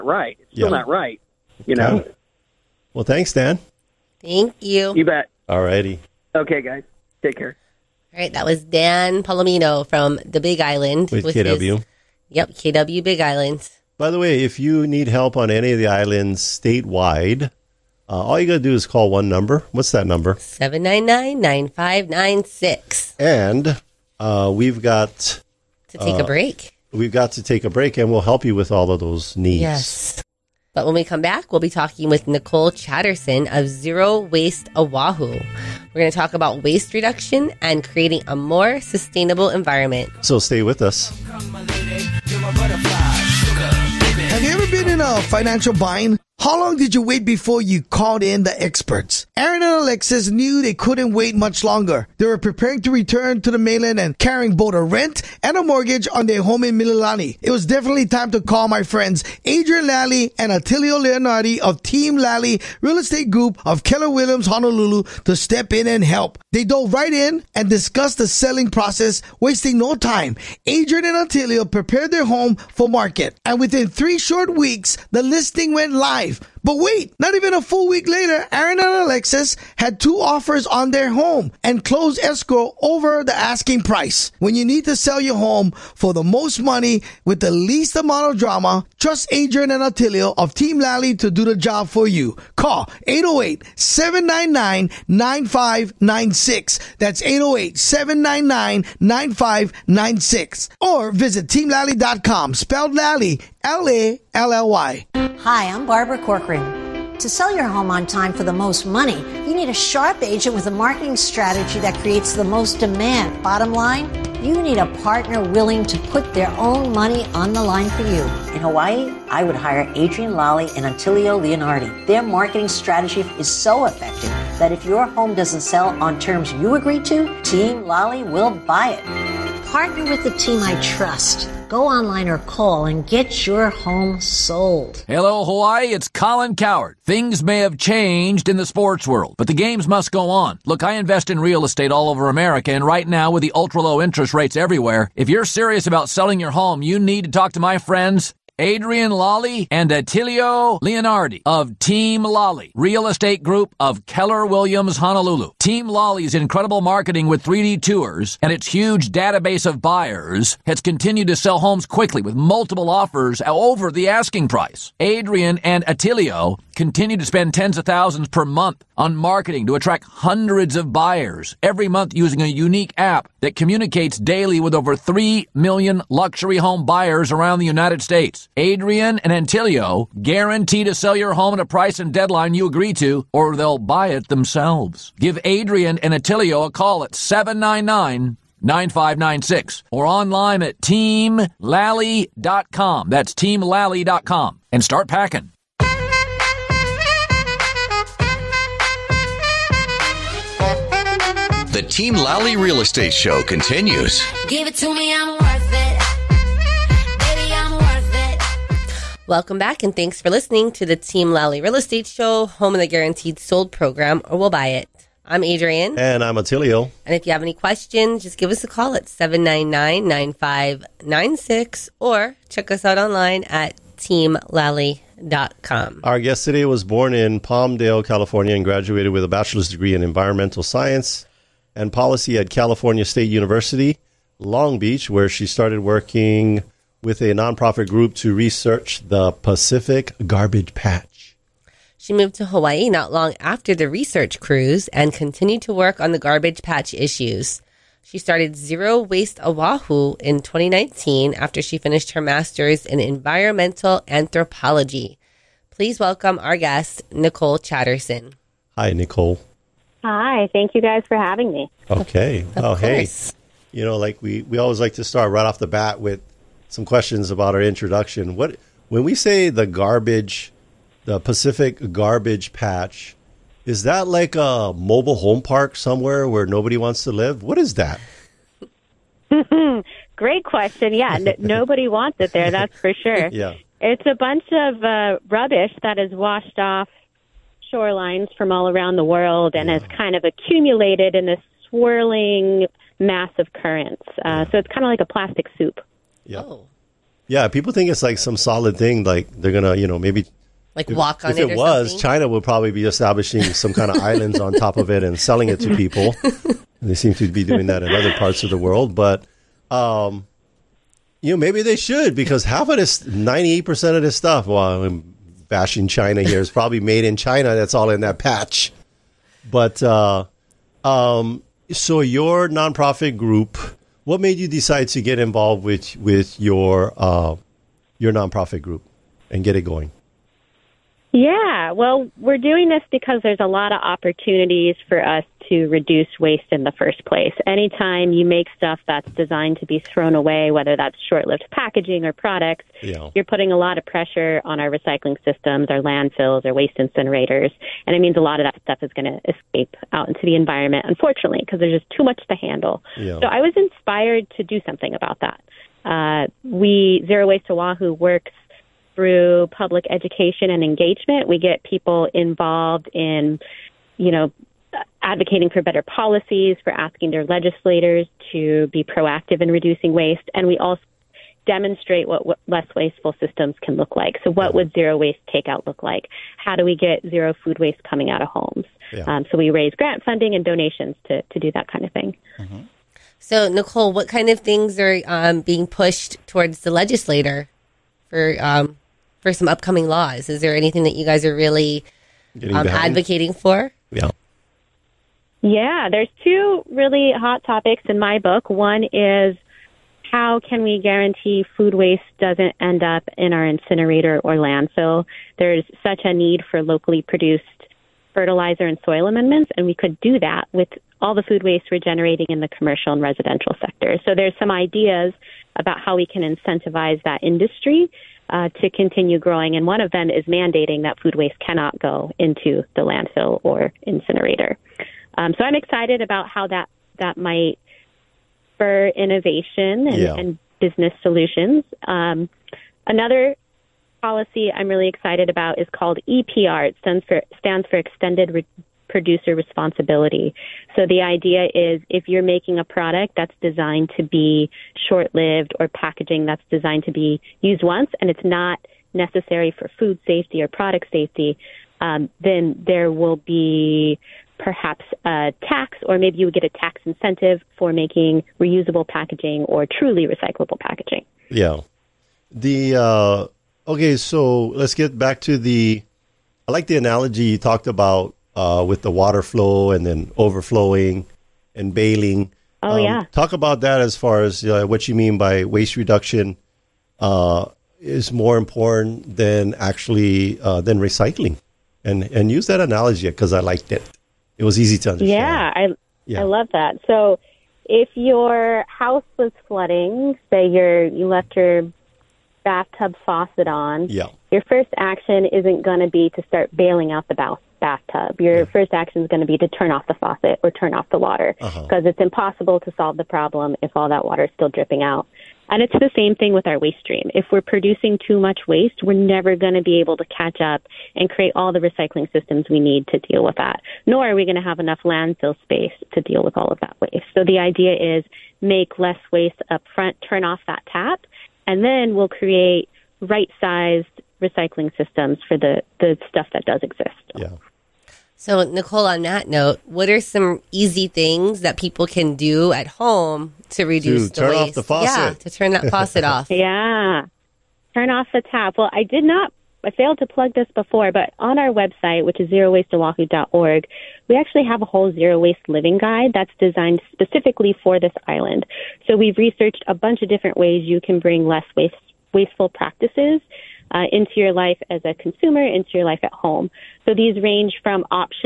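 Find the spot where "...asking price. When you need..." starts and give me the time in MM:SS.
01:23.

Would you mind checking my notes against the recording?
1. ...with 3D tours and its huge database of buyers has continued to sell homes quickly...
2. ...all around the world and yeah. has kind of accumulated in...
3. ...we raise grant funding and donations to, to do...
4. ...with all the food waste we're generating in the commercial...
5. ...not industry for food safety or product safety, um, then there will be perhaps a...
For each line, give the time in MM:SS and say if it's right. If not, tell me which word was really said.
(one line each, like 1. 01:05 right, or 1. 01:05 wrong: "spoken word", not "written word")
1. 02:37 right
2. 04:48 right
3. 06:19 right
4. 06:50 right
5. 07:28 wrong: "necessary", not "industry".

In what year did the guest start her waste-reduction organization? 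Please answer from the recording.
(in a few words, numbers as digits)
2019.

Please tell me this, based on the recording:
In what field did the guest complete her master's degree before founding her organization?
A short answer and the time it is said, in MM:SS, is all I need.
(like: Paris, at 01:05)
environmental anthropology, at 04:12.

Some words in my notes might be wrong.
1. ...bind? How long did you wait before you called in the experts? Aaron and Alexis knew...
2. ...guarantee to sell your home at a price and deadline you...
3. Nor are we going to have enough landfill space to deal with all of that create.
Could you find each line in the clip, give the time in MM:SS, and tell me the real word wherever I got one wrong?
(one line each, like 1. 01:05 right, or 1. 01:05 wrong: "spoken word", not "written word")
1. 00:45 right
2. 03:00 right
3. 08:33 wrong: "waste", not "create".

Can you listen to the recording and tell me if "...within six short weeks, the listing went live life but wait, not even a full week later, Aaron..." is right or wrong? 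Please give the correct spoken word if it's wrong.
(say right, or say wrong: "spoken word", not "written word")
wrong: "three", not "six".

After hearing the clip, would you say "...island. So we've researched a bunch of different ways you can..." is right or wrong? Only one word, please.
right.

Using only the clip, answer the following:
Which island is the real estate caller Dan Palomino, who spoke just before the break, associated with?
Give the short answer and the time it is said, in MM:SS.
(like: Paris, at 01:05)
Big Island, at 00:10.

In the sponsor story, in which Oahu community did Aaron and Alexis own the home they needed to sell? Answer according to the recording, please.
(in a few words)
Mililani.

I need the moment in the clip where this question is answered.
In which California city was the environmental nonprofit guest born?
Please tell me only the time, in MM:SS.
03:47.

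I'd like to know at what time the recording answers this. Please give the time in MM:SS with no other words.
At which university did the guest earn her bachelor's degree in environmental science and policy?
03:52.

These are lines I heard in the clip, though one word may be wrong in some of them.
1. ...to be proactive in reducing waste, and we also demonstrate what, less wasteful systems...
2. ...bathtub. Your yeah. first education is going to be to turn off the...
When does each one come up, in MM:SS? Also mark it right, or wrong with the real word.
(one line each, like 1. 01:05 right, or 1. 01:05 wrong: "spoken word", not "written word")
1. 06:08 right
2. 08:17 wrong: "action", not "education".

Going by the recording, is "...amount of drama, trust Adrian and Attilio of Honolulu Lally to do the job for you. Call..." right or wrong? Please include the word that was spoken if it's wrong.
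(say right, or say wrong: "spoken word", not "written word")
wrong: "Team", not "Honolulu".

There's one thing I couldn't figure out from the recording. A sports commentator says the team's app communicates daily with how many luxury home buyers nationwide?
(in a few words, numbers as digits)
3 million.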